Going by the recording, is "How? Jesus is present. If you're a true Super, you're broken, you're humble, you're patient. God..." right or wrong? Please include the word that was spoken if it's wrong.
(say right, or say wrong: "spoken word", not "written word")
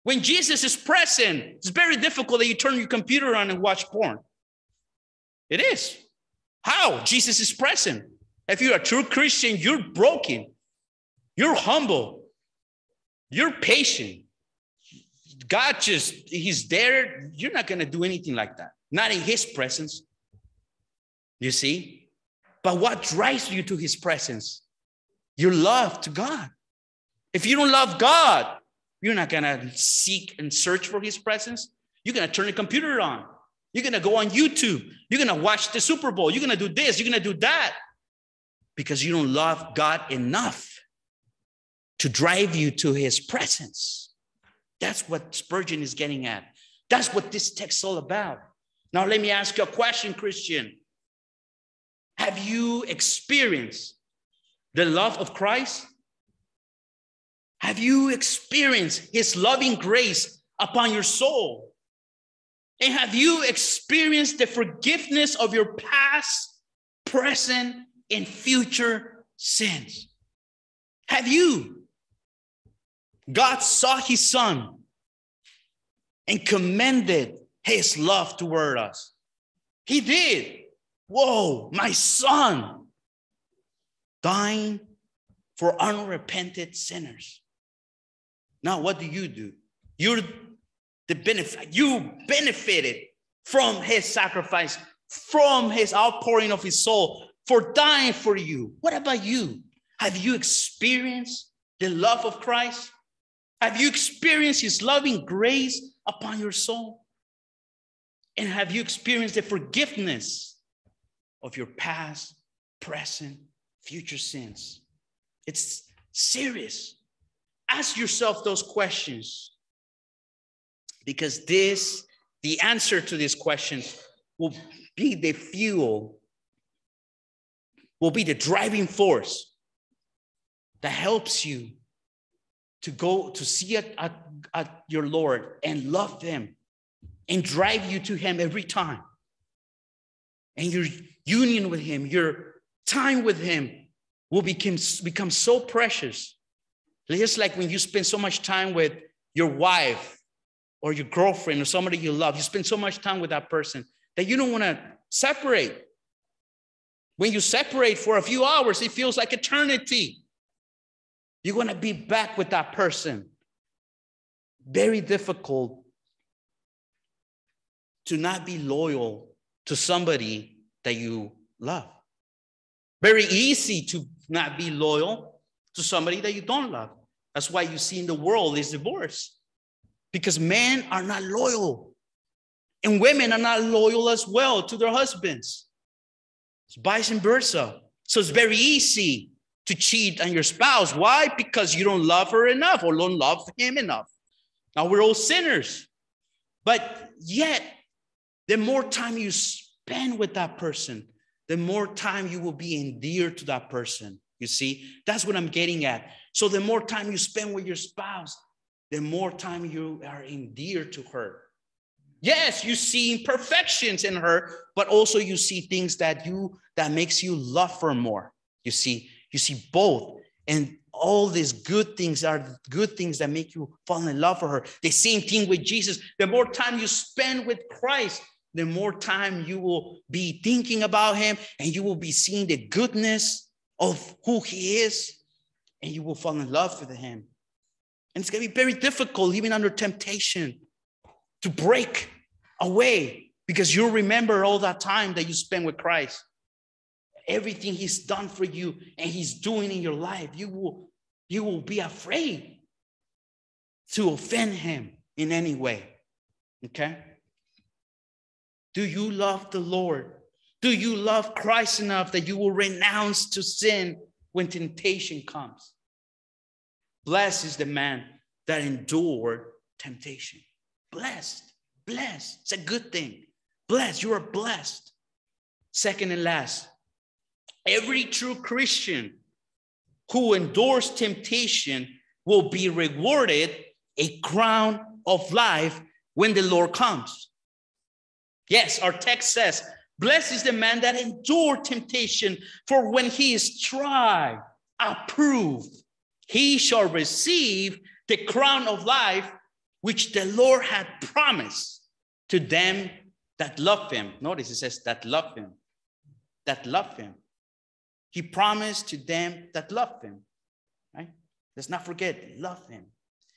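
wrong: "Christian", not "Super".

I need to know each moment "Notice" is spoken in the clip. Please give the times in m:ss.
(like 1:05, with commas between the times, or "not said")
5:04.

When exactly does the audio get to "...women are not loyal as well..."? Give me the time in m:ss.
3:02.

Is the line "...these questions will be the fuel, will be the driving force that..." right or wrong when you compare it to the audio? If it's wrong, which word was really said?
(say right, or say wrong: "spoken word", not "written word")
right.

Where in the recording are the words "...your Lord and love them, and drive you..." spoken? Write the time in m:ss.
2:14.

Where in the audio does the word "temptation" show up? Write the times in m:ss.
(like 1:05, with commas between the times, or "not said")
3:59, 4:24, 4:29, 4:40, 4:51.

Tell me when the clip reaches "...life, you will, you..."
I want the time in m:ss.
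4:09.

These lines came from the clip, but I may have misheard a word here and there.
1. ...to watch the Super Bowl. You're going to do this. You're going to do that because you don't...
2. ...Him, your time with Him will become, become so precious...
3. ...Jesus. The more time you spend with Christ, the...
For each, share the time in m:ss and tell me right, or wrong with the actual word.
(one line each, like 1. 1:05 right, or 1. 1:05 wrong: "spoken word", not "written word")
1. 0:35 right
2. 2:21 right
3. 3:45 right.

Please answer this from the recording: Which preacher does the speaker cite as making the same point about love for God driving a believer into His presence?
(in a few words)
Spurgeon.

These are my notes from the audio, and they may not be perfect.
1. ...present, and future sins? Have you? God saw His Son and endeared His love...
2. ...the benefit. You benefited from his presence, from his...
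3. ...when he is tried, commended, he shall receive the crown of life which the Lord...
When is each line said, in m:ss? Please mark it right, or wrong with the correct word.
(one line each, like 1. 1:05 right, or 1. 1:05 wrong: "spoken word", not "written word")
1. 1:07 wrong: "commended", not "endeared"
2. 1:31 wrong: "sacrifice", not "presence"
3. 4:52 wrong: "approved", not "commended".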